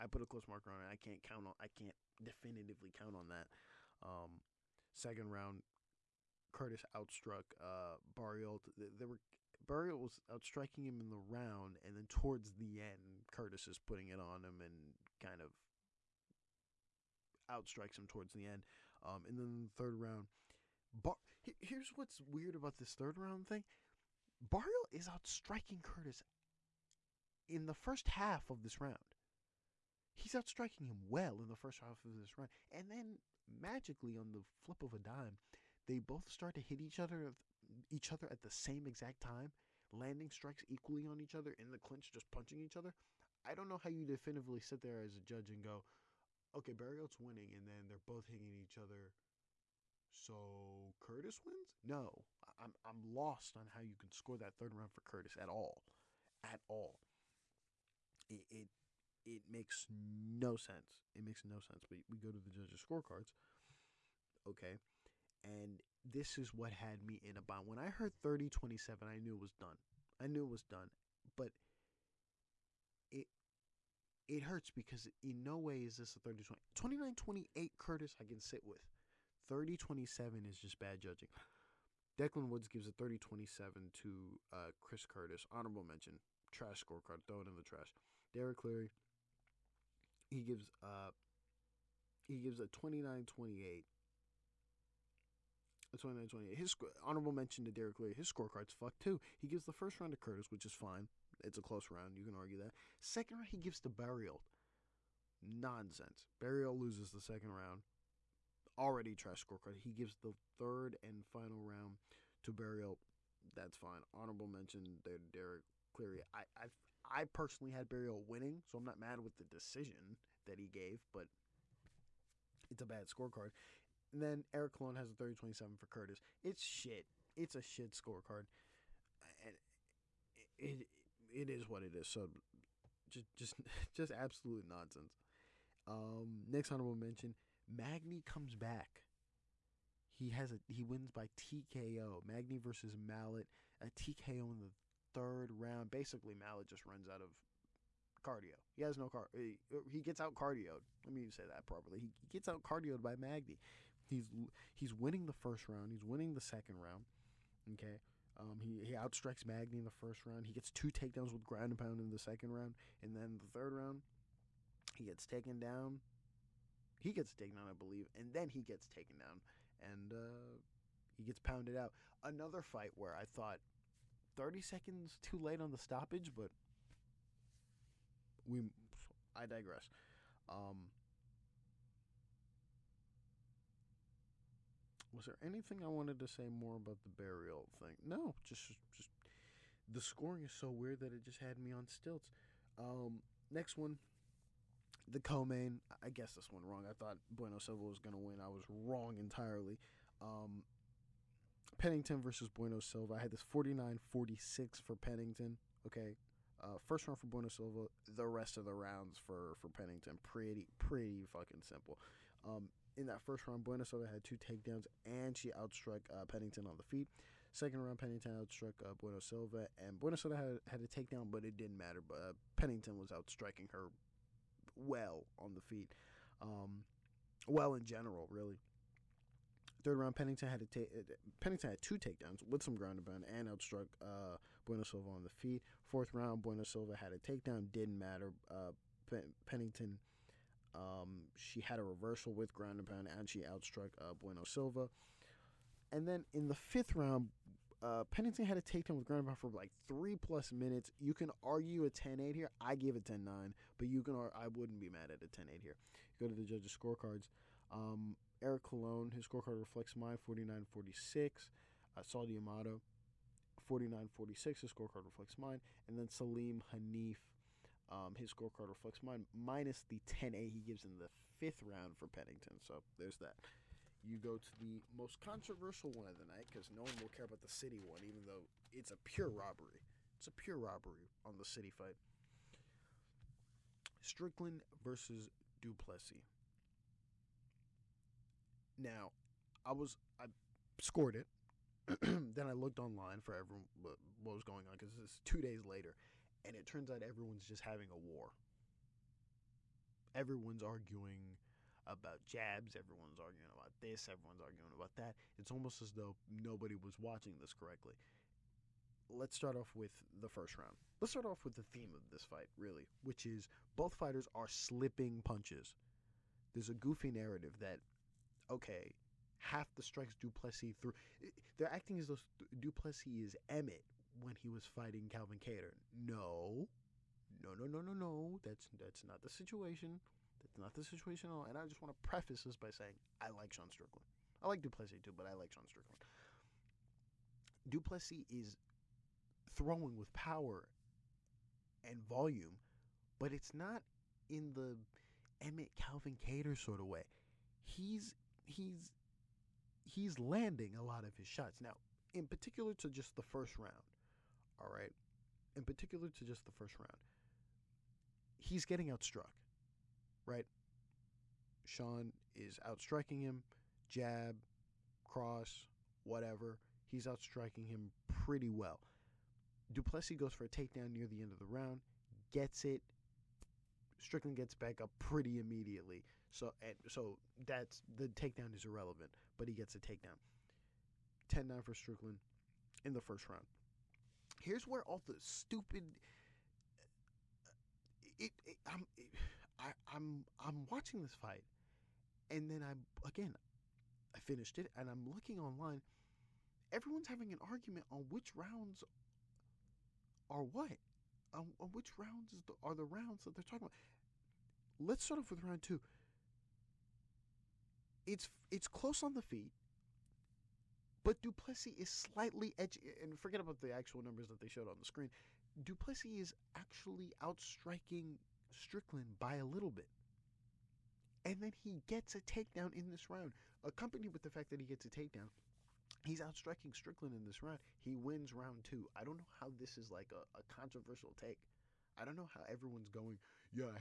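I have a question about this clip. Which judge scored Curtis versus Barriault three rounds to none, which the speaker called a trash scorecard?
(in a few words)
Declan Woods.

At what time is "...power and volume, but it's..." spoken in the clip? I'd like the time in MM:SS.
05:40.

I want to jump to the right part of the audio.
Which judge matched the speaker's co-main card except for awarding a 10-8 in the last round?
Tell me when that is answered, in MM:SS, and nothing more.
04:26.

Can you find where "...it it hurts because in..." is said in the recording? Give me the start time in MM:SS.
01:13.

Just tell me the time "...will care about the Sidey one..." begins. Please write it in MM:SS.
04:36.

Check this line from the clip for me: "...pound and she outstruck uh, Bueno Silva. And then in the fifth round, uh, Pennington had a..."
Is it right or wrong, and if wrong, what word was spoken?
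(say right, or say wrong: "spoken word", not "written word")
right.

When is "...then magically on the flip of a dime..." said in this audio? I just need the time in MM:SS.
00:32.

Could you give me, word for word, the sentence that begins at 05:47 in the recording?
He's he's he's landing a lot of his shots.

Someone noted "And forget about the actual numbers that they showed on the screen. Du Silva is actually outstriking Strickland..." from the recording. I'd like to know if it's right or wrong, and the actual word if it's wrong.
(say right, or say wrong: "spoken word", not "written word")
wrong: "Plessis", not "Silva".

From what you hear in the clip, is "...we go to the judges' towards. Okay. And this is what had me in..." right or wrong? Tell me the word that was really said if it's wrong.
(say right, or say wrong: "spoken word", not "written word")
wrong: "scorecards", not "towards".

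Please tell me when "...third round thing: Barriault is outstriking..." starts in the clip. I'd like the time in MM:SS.
00:22.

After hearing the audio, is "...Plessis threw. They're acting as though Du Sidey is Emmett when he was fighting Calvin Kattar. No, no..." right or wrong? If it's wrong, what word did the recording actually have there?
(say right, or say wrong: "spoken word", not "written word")
wrong: "Plessis", not "Sidey".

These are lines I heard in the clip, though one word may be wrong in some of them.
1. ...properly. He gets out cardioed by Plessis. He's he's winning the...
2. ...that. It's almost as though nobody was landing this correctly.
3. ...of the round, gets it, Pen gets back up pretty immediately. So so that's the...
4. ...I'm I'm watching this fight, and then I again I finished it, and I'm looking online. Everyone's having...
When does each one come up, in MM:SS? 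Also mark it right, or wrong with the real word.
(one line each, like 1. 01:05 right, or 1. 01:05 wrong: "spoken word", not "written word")
1. 02:31 wrong: "Magny", not "Plessis"
2. 05:04 wrong: "watching", not "landing"
3. 06:11 wrong: "Strickland", not "Pen"
4. 06:29 right.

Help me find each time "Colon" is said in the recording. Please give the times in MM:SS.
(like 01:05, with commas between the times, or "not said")
02:04, 04:18.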